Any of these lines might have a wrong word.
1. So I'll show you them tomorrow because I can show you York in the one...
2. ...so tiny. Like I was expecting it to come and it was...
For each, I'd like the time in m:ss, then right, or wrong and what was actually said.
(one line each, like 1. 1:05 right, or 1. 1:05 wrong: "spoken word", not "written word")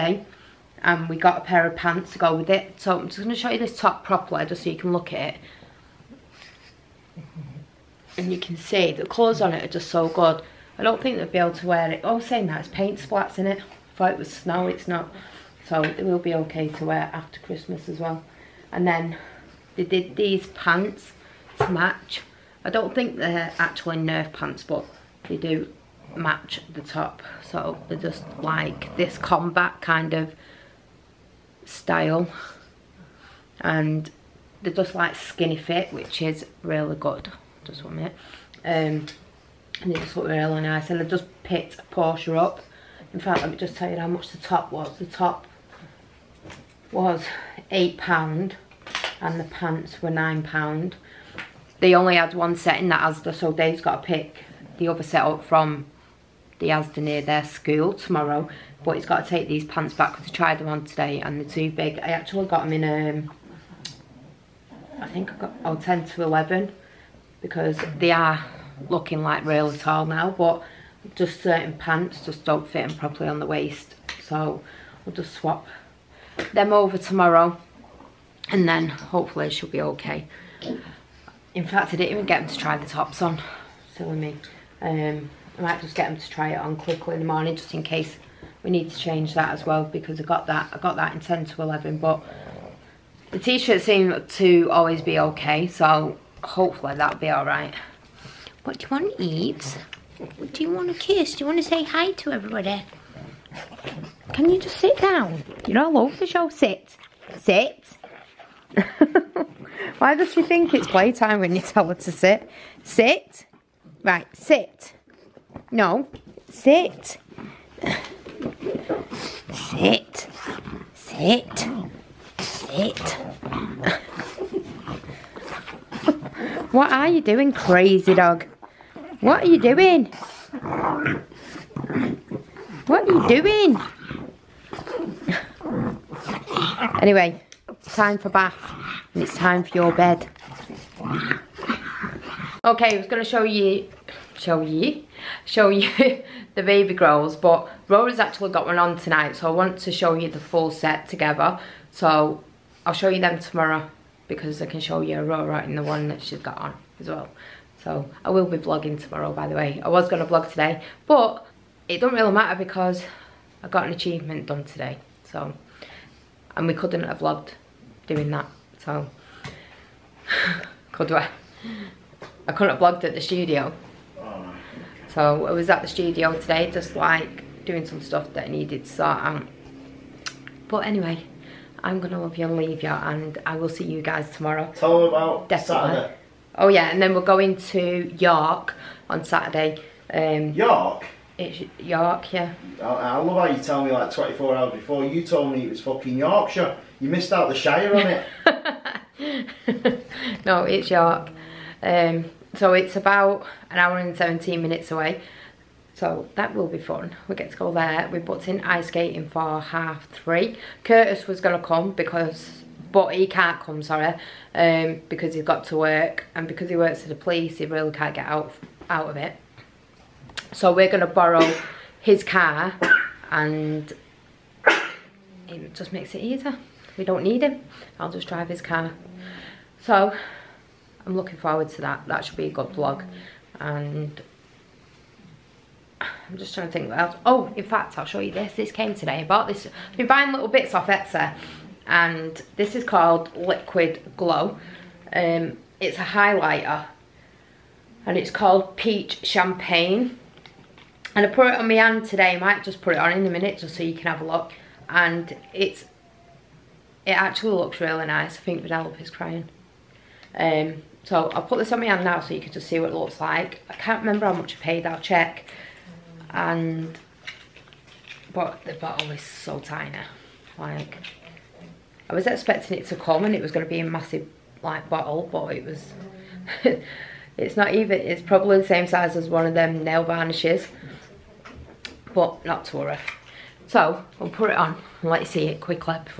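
1. 2:31 wrong: "Aurora", not "York"
2. 4:29 right.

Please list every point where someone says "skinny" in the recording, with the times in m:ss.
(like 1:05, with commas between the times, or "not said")
0:35.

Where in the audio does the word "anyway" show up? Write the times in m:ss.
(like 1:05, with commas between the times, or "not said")
2:17, 3:00.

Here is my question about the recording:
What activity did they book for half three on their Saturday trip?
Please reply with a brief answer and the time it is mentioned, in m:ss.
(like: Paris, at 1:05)
Ice skating, at 3:28.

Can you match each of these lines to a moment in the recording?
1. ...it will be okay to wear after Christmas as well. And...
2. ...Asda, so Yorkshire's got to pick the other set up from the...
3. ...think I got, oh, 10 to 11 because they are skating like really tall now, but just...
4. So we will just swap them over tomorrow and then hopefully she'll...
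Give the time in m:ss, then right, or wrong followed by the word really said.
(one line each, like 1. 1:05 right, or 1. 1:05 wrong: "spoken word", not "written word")
1. 0:15 right
2. 0:53 wrong: "Dave", not "Yorkshire"
3. 1:05 wrong: "looking", not "skating"
4. 1:14 right.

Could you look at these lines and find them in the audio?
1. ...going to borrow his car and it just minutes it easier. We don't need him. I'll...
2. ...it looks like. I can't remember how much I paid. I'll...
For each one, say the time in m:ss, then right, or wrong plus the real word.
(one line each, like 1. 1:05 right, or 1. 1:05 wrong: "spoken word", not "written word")
1. 3:40 wrong: "makes", not "minutes"
2. 4:22 right.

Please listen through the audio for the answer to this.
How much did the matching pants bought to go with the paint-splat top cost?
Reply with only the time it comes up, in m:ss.
0:49.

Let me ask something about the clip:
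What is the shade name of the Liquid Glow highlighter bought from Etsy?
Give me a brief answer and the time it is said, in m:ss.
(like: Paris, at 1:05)
Peach Champagne, at 4:08.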